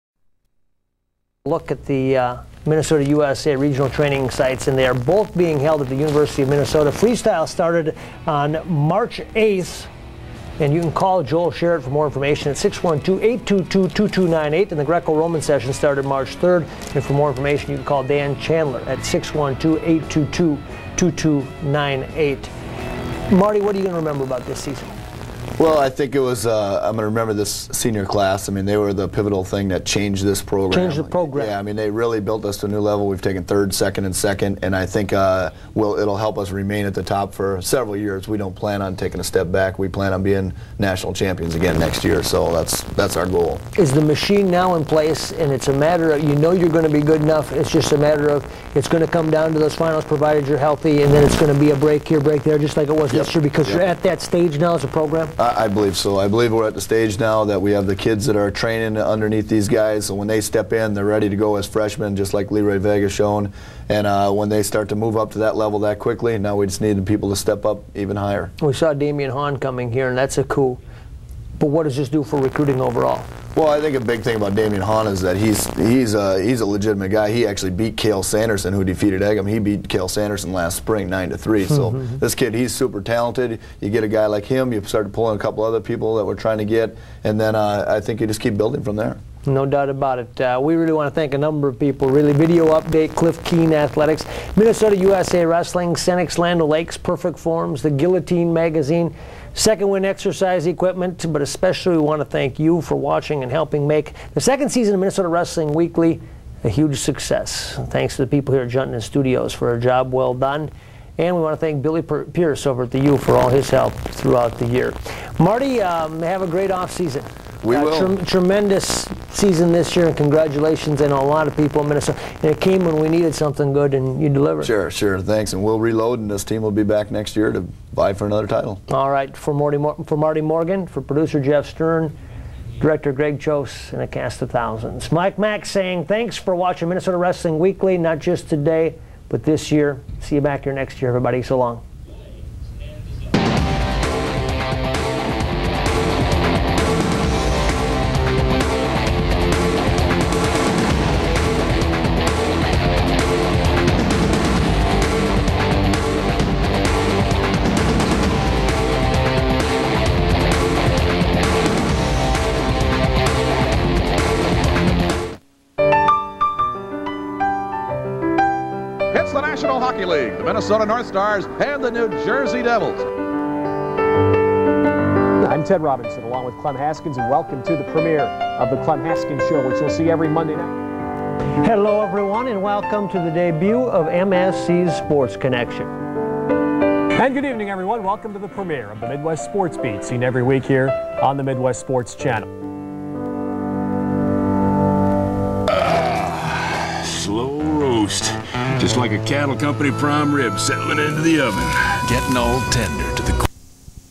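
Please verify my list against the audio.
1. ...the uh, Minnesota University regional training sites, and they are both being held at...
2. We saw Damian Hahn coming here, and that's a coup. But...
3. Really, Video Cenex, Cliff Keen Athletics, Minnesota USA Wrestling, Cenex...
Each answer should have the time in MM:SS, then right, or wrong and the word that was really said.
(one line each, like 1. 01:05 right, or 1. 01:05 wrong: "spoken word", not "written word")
1. 00:01 wrong: "USA", not "University"
2. 01:08 right
3. 01:32 wrong: "Update", not "Cenex".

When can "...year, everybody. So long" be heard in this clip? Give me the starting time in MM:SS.
02:21.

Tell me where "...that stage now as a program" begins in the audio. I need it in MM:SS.
00:54.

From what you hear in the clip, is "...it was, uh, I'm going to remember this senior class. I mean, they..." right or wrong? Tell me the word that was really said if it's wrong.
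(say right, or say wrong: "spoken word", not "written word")
right.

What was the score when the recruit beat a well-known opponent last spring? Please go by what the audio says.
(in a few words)
9 to 3.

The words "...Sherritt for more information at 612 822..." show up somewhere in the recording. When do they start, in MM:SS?
00:11.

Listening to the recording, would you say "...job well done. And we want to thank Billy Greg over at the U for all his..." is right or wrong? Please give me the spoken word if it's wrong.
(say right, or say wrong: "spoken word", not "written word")
wrong: "Pierce", not "Greg".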